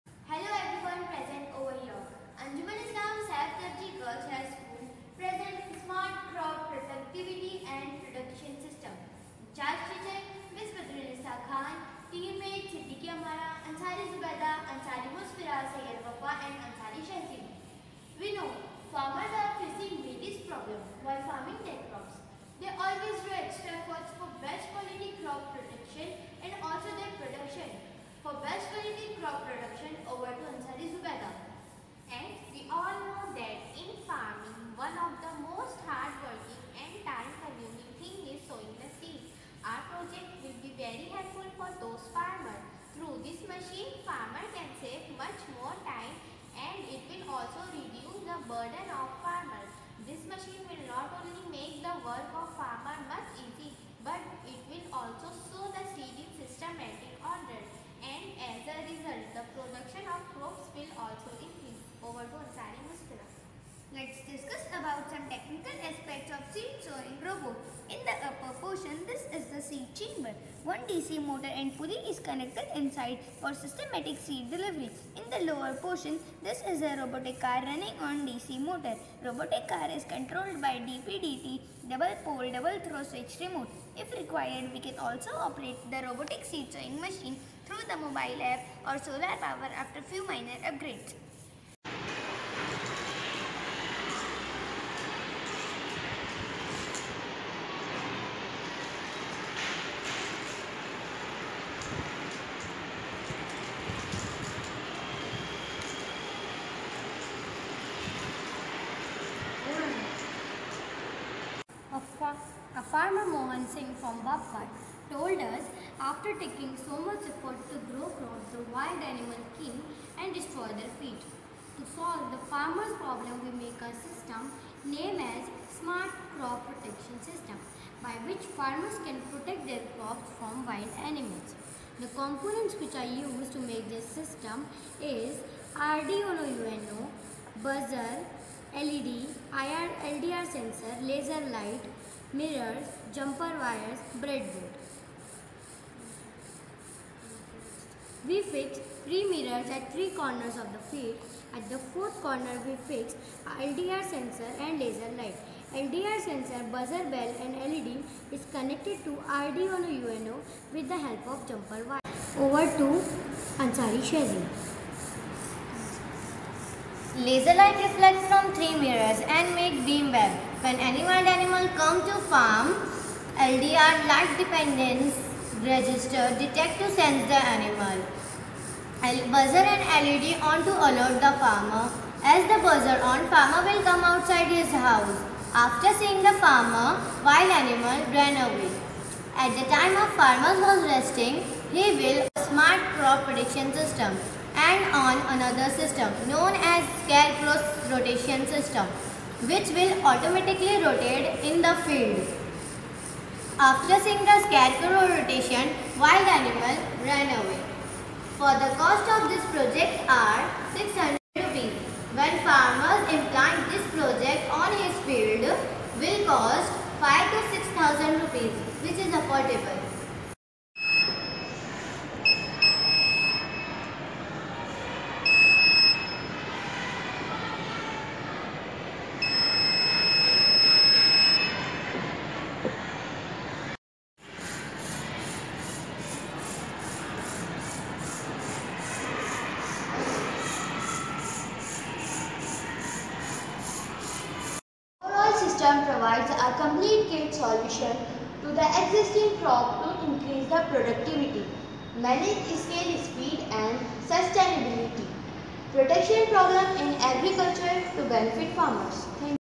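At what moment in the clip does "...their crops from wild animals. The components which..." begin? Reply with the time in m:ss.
2:09.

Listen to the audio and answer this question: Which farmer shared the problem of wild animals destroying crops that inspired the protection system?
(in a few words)
Mohan Singh.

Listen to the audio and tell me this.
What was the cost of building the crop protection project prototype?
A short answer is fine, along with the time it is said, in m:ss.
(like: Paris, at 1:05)
600 rupees, at 3:30.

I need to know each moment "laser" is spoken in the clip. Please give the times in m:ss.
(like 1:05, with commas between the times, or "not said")
2:21, 2:34, 2:47.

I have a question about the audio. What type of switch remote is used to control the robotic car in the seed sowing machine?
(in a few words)
DPDT.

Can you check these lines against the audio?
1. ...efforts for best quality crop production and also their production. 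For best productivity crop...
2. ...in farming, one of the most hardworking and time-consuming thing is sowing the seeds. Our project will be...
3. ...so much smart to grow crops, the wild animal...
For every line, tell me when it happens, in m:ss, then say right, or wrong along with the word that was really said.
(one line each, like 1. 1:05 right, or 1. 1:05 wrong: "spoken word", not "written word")
1. 0:23 wrong: "quality", not "productivity"
2. 0:33 right
3. 1:56 wrong: "effort", not "smart".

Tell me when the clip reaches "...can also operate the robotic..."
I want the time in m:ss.
1:24.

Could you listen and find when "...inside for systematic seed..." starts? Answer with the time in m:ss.
1:12.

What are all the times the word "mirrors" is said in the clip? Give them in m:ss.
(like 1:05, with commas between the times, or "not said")
2:22, 2:29, 2:48.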